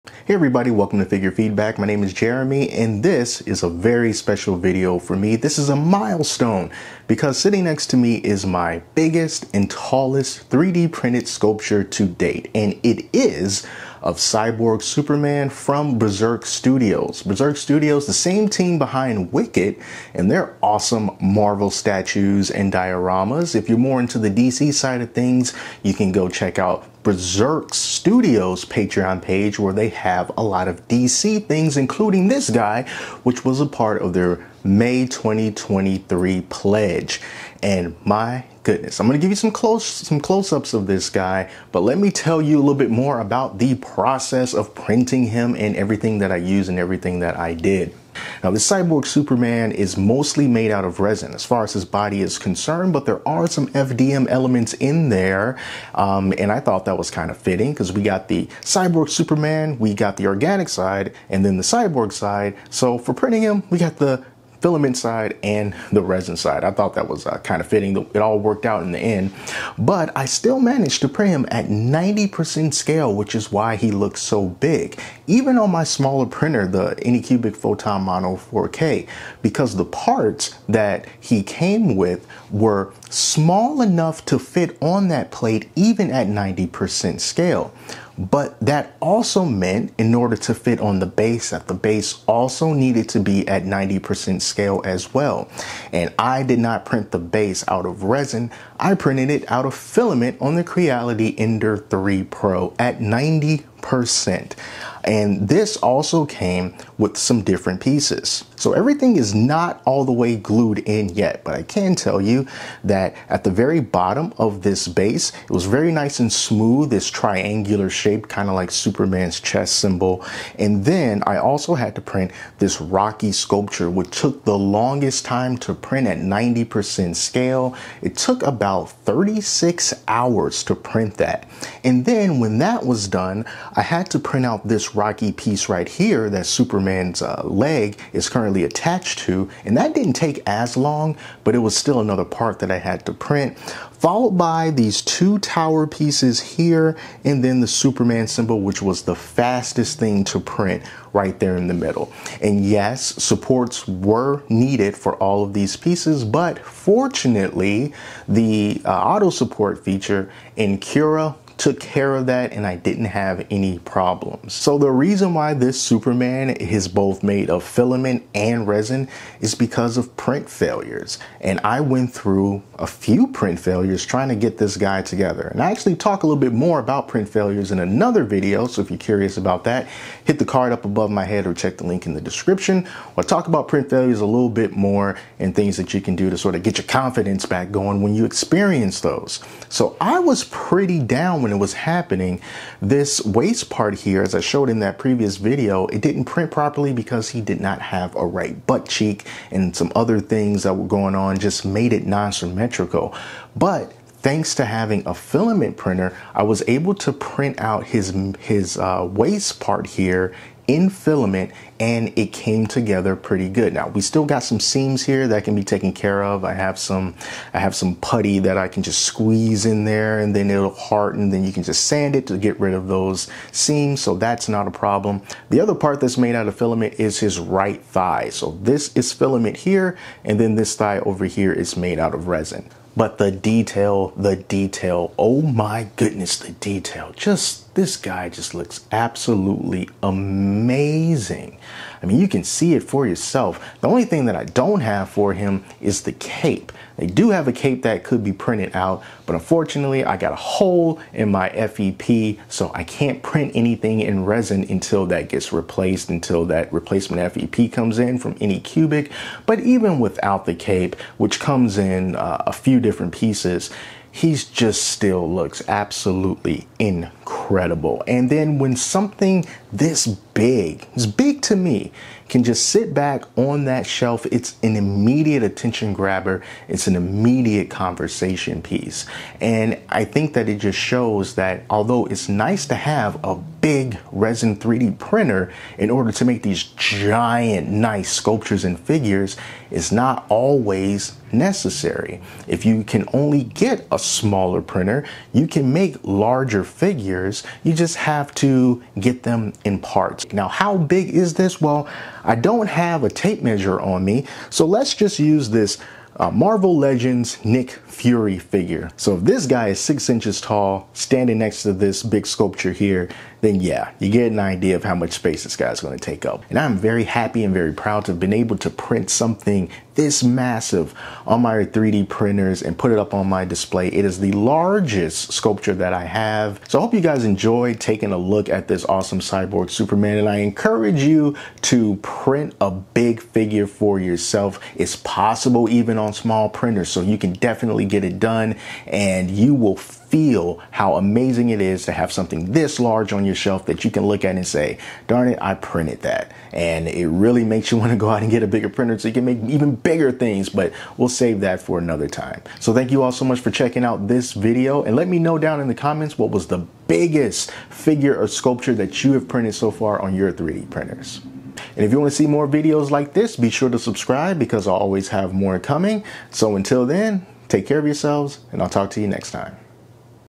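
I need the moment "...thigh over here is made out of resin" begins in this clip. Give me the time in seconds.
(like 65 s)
230 s.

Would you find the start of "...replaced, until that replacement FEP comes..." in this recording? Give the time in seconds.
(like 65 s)
255 s.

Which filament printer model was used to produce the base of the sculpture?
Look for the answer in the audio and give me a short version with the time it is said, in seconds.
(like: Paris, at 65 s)
Creality Ender 3 Pro, at 100 s.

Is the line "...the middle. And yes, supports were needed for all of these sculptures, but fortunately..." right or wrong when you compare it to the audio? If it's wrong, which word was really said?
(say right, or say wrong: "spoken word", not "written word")
wrong: "pieces", not "sculptures".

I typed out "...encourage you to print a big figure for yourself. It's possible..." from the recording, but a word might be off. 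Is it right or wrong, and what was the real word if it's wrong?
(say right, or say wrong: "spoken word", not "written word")
right.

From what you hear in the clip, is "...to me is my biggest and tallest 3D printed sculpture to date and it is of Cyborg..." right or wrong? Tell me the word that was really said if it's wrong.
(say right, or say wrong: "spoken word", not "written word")
right.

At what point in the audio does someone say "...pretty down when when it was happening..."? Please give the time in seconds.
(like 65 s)
190 s.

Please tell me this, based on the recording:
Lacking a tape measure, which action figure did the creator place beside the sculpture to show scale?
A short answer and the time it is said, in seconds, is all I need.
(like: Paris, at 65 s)
Marvel Legends Nick Fury, at 306 s.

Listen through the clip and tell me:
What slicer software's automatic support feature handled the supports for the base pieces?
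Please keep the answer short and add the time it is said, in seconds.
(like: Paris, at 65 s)
Cura, at 160 s.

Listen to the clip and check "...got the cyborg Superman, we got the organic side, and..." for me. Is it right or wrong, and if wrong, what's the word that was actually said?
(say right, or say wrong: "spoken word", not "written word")
right.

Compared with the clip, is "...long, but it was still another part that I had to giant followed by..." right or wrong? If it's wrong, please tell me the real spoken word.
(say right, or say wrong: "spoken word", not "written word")
wrong: "print", not "giant".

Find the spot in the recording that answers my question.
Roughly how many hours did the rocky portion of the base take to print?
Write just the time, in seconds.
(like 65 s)
128 s.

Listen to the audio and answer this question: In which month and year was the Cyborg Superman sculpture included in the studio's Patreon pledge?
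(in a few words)
May 2023.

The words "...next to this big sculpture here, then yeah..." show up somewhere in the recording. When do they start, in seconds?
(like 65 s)
311 s.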